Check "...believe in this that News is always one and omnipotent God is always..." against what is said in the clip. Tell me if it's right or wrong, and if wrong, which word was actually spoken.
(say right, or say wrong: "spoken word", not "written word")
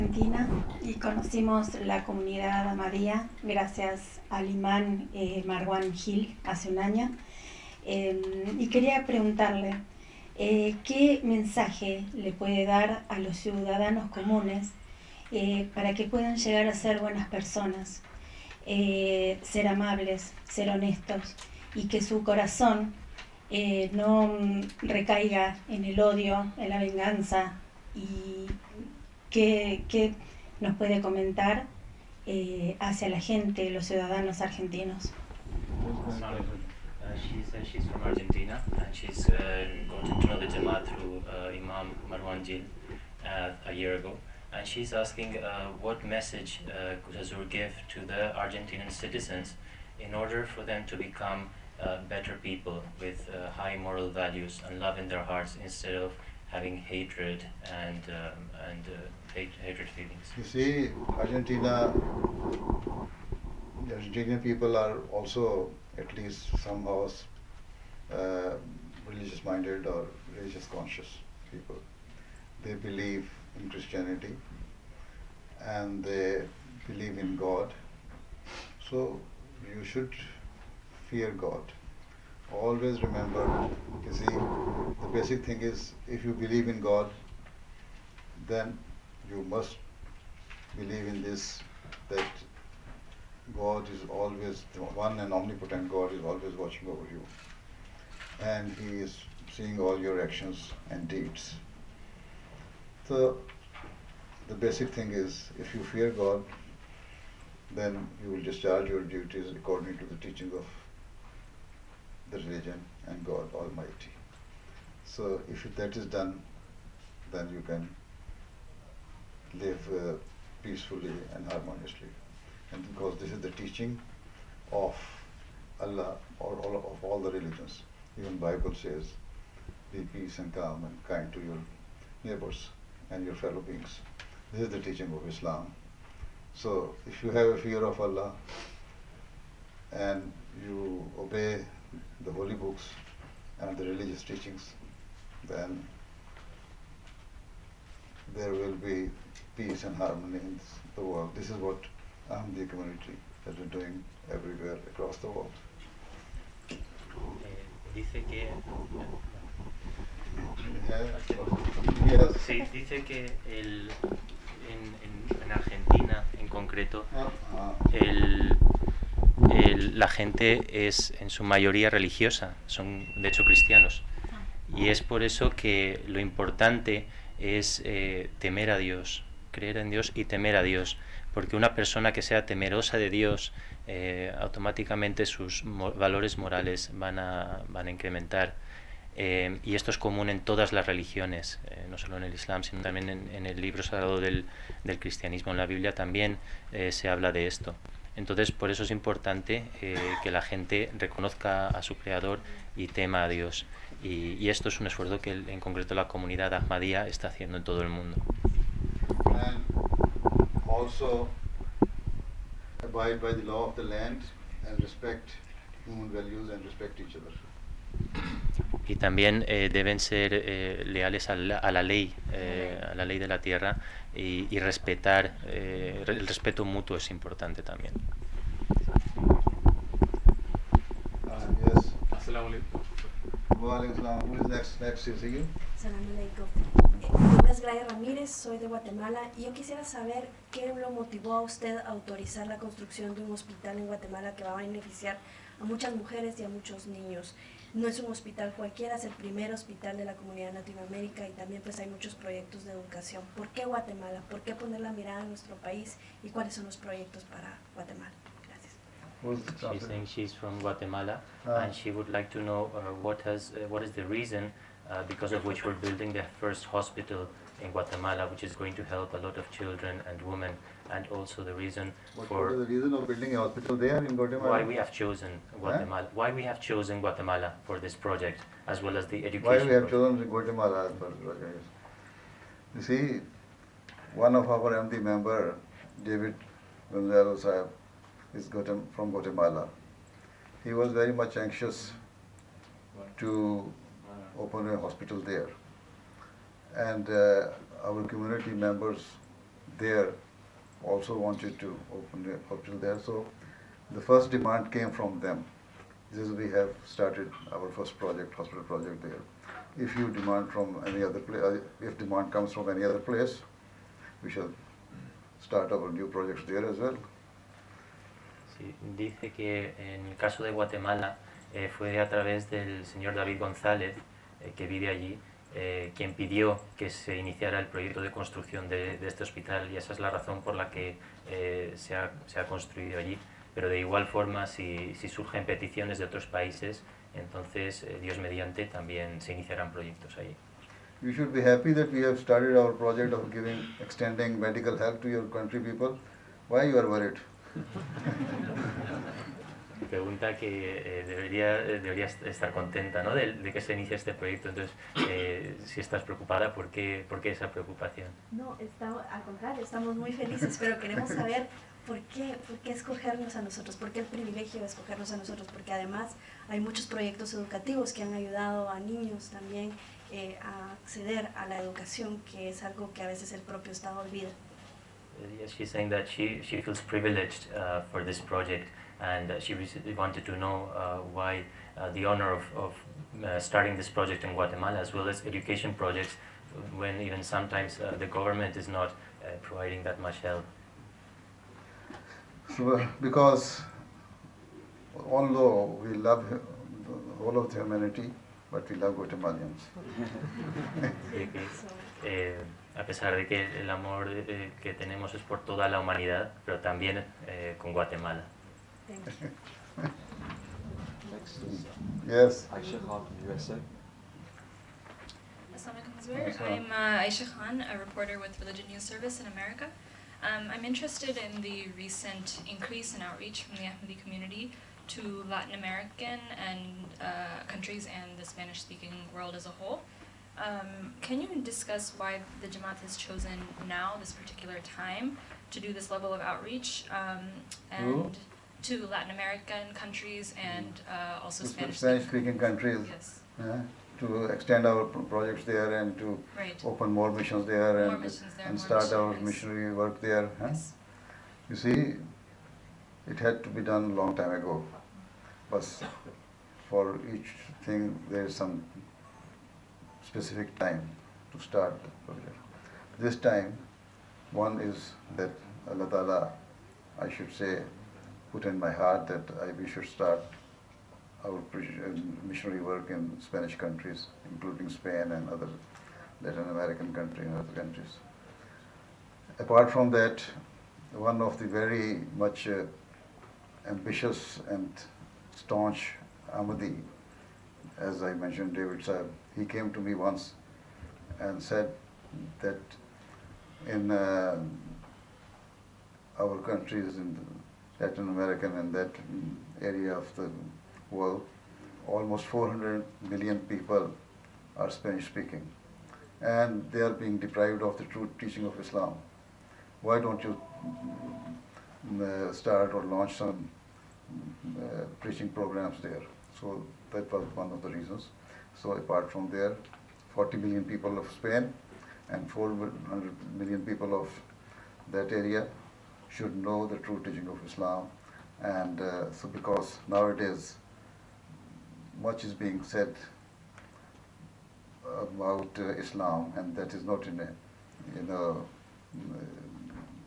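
wrong: "God", not "News".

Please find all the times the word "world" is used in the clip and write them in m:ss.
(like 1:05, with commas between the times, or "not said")
2:31, 7:09, 8:20.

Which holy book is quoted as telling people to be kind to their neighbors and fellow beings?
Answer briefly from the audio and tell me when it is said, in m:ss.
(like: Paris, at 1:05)
Bible, at 2:08.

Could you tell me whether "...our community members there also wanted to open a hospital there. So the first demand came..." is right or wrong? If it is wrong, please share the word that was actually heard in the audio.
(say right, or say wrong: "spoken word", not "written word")
right.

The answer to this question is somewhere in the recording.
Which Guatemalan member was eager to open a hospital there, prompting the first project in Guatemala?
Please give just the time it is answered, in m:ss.
4:46.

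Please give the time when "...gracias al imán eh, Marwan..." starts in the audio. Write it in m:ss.
0:03.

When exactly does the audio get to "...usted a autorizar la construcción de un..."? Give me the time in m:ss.
4:01.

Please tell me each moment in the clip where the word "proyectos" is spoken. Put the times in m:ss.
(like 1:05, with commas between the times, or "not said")
4:12, 4:16, 5:27, 5:39, 5:54, 6:06.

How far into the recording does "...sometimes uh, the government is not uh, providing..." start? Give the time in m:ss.
6:27.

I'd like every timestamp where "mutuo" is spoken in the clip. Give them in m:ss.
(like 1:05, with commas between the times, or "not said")
3:46.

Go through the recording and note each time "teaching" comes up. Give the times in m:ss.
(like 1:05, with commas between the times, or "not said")
1:50, 2:03, 2:14, 2:24, 8:28, 8:47.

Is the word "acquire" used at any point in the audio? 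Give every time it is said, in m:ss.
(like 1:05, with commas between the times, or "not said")
not said.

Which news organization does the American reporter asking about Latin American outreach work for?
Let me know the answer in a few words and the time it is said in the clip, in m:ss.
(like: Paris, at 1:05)
Religion News Service, at 6:58.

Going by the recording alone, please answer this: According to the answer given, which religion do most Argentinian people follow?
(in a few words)
Christianity.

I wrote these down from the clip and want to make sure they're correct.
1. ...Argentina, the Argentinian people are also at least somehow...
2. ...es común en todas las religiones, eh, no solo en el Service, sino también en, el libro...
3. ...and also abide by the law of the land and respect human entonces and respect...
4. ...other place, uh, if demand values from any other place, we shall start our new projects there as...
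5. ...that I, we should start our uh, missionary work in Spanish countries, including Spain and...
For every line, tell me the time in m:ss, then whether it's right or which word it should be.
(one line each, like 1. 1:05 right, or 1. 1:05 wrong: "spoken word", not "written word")
1. 1:01 right
2. 3:09 wrong: "Islam", not "Service"
3. 3:29 wrong: "values", not "entonces"
4. 5:11 wrong: "comes", not "values"
5. 7:49 right.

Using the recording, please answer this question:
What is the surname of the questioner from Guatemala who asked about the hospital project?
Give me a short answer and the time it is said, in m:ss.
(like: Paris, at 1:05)
Ramírez, at 3:57.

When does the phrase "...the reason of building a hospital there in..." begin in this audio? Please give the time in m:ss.
4:32.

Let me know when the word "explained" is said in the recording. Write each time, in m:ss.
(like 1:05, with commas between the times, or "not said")
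not said.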